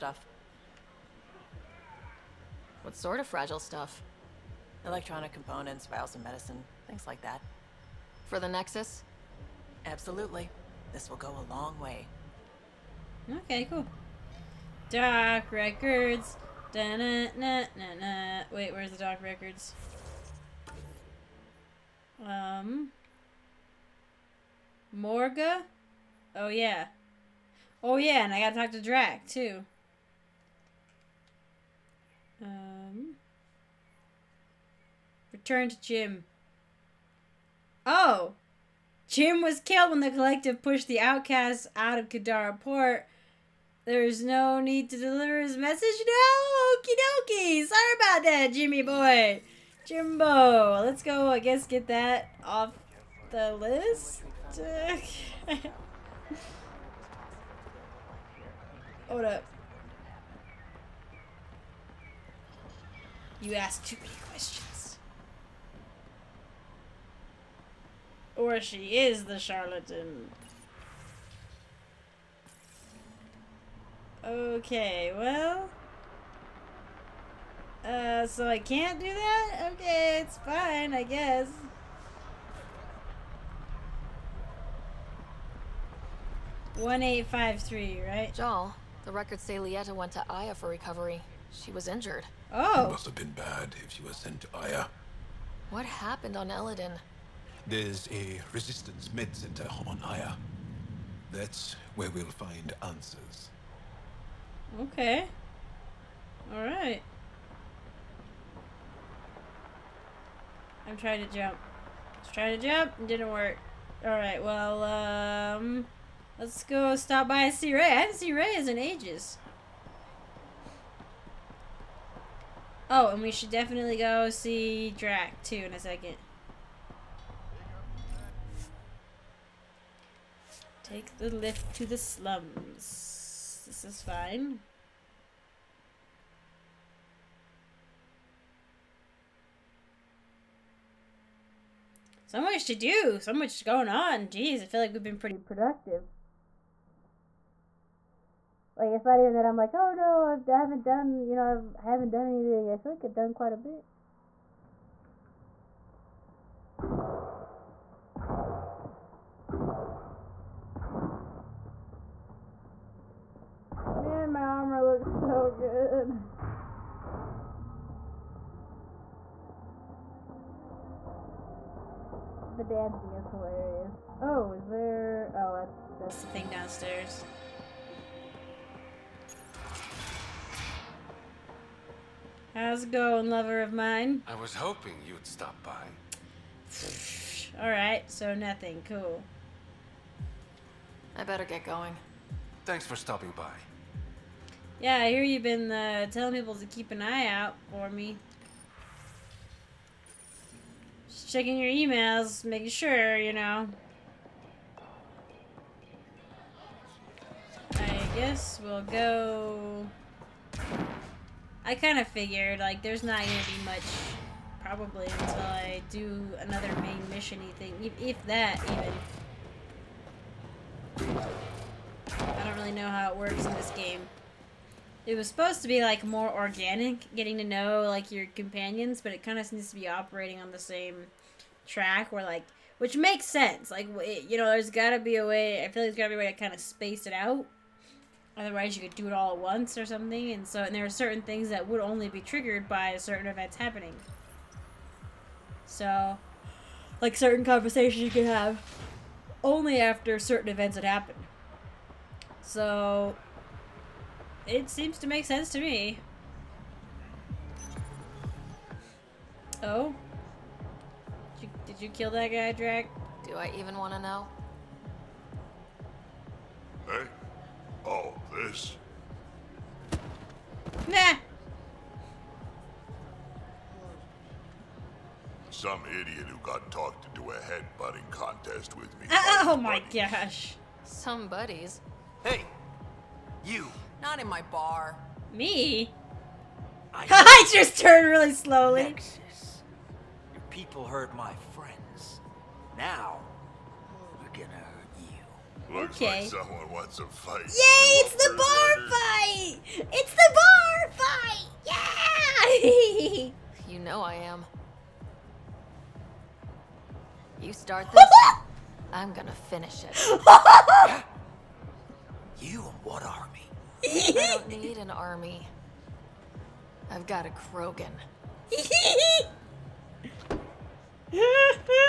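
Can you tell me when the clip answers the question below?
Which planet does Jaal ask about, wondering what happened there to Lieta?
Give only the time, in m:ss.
1:36.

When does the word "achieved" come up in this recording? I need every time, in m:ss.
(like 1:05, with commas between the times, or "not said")
not said.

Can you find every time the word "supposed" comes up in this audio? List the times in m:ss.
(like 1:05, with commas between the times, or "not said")
3:45.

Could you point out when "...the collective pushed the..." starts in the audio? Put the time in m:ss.
0:39.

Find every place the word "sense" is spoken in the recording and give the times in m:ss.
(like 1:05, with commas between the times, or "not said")
3:53, 4:15.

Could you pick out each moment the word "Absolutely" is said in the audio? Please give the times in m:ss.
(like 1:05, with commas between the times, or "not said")
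0:09.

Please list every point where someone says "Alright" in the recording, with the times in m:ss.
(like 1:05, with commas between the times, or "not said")
3:07.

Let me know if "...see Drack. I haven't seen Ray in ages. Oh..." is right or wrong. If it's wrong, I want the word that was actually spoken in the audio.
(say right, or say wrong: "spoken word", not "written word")
wrong: "Ray", not "Drack".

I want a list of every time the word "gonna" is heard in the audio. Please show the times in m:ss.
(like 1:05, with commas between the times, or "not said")
4:54, 5:09.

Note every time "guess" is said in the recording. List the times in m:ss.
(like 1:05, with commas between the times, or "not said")
0:51, 1:21, 3:28.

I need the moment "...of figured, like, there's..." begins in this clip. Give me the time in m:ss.
3:31.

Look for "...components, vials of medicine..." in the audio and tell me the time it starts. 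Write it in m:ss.
0:05.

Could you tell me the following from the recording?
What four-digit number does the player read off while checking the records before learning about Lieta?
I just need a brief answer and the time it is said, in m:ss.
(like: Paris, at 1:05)
1853, at 1:26.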